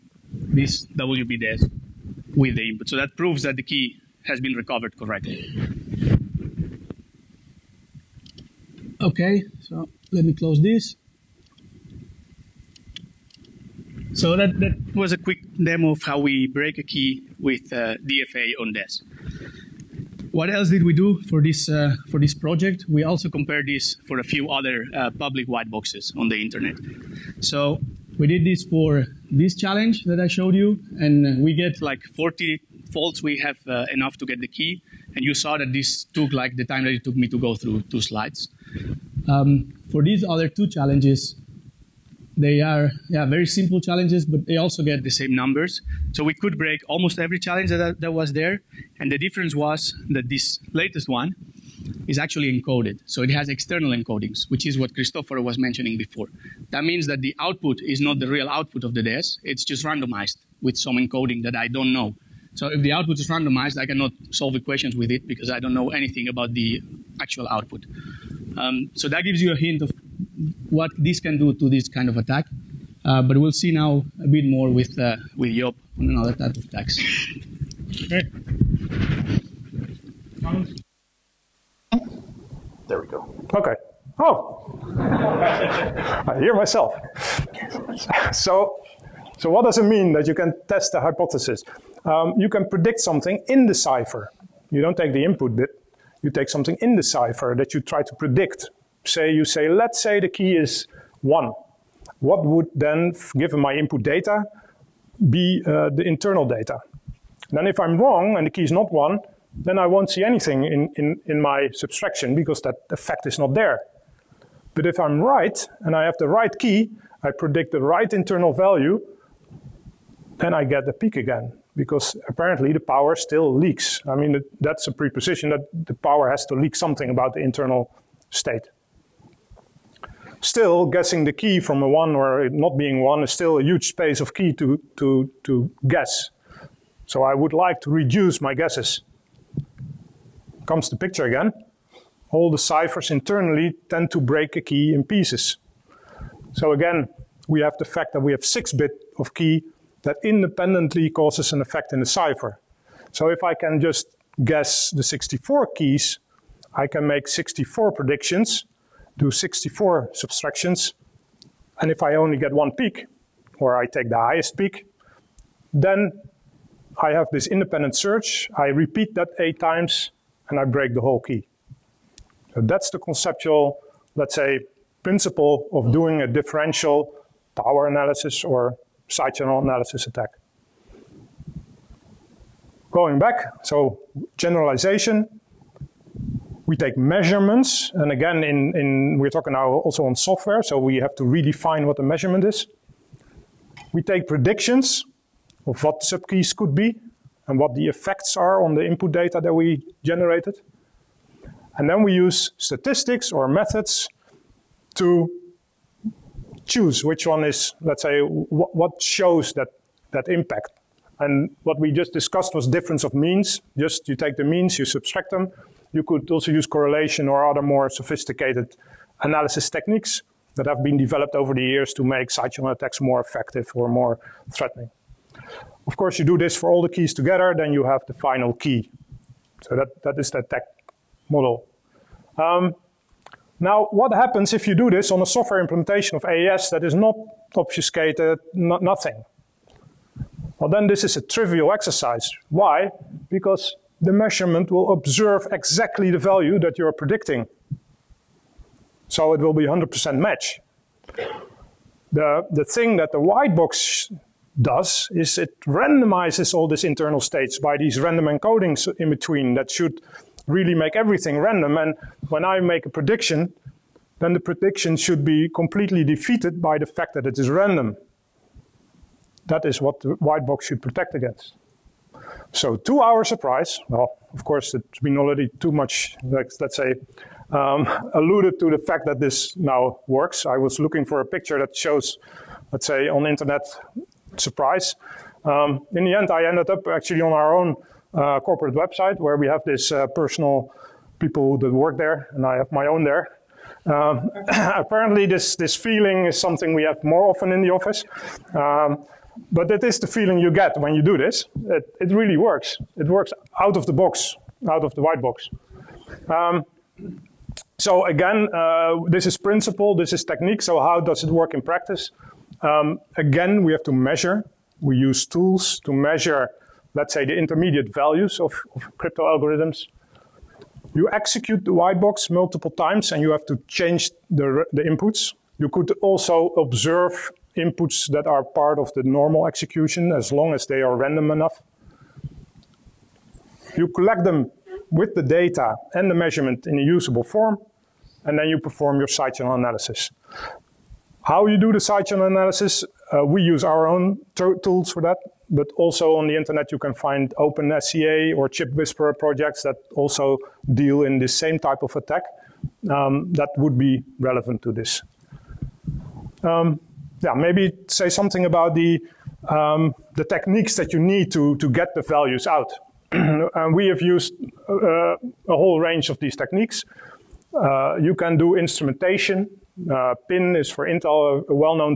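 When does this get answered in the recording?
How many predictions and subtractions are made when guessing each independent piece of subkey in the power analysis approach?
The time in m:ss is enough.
2:37.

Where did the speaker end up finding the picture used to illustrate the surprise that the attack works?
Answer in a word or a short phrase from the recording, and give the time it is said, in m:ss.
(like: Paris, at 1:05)
Corporate website, at 4:48.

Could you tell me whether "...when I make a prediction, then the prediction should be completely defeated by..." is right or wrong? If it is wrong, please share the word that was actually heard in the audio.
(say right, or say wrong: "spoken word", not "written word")
right.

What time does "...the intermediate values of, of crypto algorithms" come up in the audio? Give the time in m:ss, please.
5:17.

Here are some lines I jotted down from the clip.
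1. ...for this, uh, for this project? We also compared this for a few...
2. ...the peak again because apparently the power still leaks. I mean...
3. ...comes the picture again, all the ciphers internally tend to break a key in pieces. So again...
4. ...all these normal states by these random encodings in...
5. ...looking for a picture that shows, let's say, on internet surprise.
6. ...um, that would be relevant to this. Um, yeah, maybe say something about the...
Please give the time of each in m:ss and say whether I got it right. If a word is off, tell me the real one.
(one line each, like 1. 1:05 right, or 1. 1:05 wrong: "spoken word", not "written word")
1. 0:21 right
2. 2:00 right
3. 2:20 right
4. 4:16 wrong: "internal", not "normal"
5. 4:40 right
6. 5:52 right.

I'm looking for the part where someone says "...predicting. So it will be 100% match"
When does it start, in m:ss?
4:06.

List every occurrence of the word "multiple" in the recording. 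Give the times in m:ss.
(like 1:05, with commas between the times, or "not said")
5:22.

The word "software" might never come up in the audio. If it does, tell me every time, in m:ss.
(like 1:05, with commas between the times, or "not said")
3:10, 3:55.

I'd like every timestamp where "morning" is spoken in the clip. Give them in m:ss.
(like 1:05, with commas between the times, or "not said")
not said.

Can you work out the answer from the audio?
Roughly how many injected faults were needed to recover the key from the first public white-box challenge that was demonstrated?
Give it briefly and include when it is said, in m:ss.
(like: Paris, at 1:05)
40, at 0:32.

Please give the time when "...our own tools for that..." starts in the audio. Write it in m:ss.
5:43.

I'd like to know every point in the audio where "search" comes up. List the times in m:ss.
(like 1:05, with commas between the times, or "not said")
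2:47.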